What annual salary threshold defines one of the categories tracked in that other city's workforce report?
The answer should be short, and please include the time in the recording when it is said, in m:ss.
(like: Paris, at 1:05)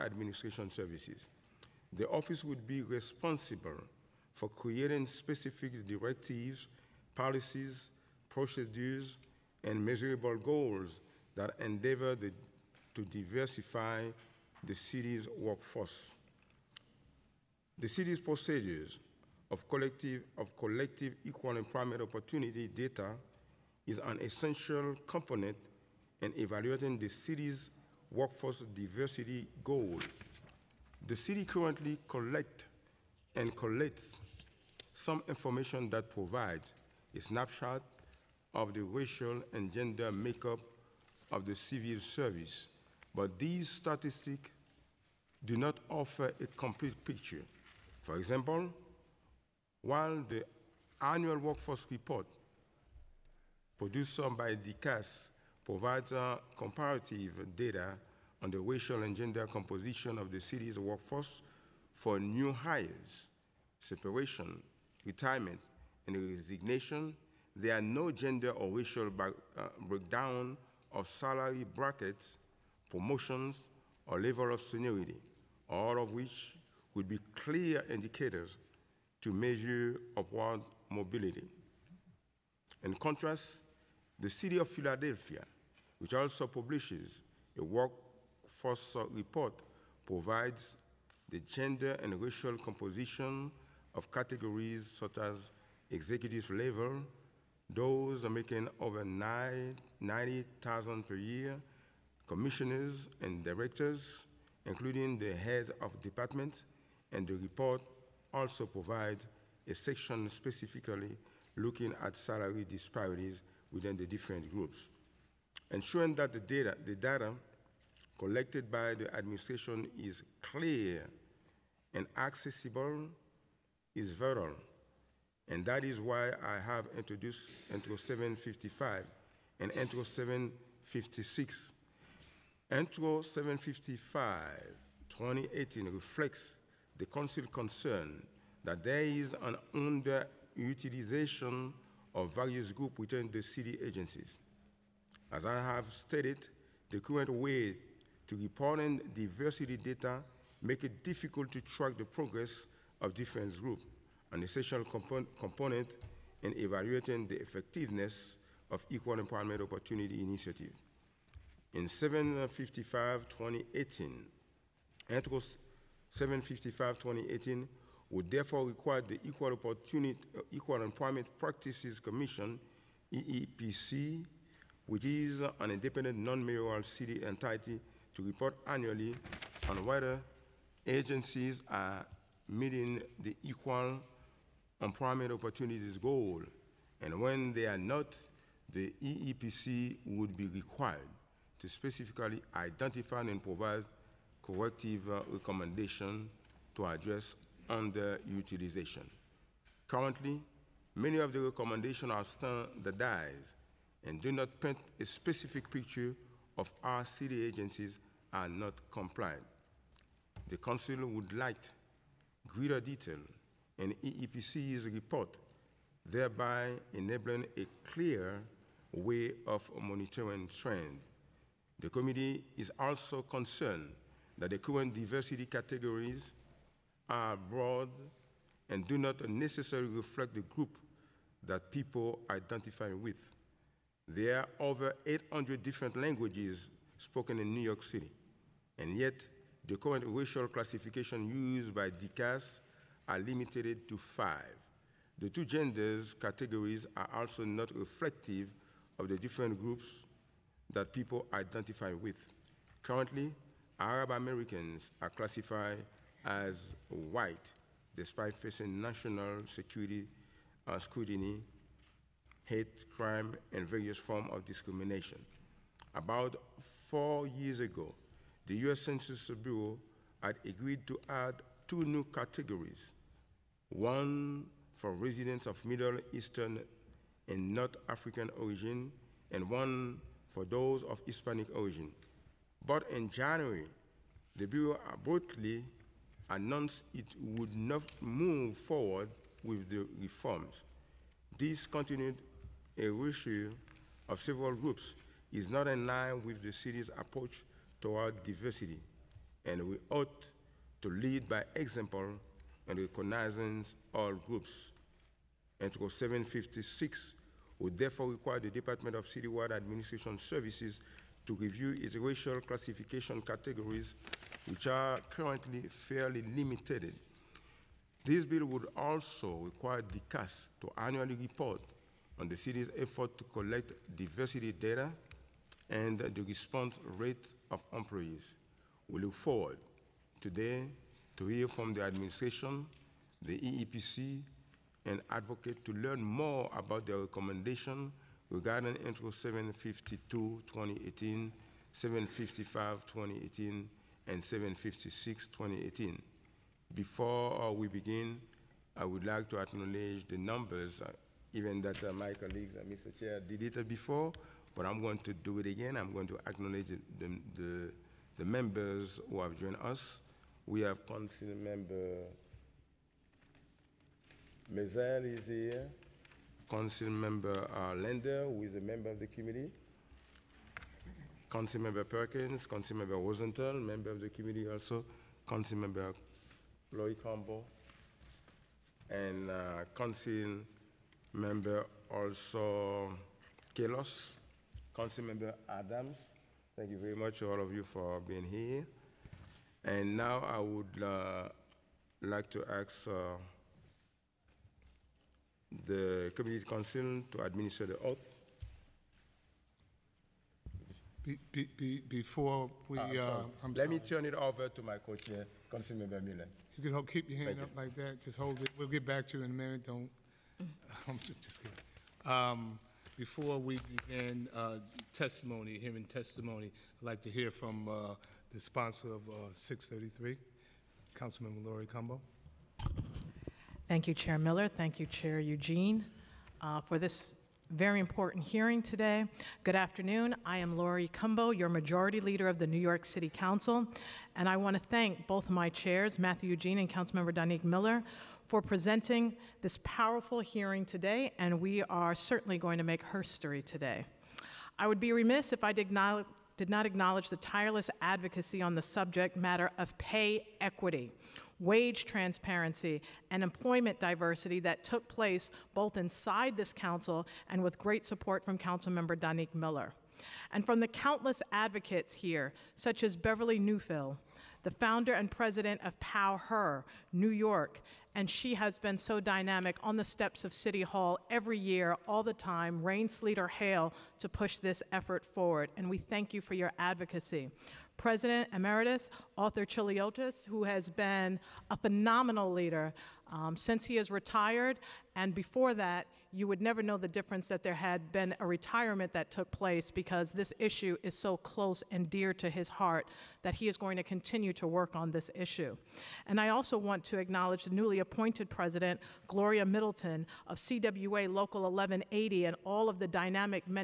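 90,000, at 1:39.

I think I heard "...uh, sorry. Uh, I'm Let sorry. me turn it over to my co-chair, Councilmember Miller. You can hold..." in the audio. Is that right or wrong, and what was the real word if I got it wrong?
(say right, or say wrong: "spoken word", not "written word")
right.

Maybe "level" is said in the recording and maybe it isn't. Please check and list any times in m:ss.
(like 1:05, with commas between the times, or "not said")
1:14, 1:36.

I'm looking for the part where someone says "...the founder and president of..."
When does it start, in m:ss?
7:44.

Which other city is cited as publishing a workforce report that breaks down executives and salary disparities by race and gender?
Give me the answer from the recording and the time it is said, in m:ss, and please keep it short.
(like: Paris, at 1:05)
Philadelphia, at 1:24.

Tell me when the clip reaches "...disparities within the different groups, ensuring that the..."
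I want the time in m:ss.
1:52.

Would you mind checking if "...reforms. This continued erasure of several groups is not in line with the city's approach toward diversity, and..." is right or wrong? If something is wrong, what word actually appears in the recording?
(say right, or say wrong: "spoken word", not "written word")
right.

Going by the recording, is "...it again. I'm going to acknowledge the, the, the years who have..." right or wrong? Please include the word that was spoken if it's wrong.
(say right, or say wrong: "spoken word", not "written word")
wrong: "members", not "years".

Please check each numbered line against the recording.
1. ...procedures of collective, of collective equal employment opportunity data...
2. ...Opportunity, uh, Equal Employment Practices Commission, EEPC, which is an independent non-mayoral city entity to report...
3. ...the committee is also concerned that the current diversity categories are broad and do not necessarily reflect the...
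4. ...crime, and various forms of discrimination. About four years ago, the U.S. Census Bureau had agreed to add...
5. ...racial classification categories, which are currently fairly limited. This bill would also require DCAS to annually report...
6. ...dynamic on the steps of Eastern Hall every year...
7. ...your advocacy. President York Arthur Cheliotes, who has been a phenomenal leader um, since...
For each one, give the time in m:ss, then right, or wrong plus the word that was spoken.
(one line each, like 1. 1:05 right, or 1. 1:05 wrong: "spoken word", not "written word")
1. 0:18 right
2. 2:49 right
3. 3:41 right
4. 4:22 right
5. 5:11 right
6. 7:48 wrong: "City", not "Eastern"
7. 7:56 wrong: "Emeritus", not "York".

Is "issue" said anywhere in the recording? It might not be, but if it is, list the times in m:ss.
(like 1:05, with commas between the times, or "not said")
8:10, 8:15.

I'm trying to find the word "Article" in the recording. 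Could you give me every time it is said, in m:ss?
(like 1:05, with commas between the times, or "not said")
2:45, 5:05.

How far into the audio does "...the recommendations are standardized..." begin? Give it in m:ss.
3:21.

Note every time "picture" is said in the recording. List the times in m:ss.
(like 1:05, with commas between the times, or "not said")
0:47, 3:25.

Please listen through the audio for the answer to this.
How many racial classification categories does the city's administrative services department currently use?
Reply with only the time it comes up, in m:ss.
4:03.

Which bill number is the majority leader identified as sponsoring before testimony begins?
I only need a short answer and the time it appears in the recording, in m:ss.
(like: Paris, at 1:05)
633, at 6:59.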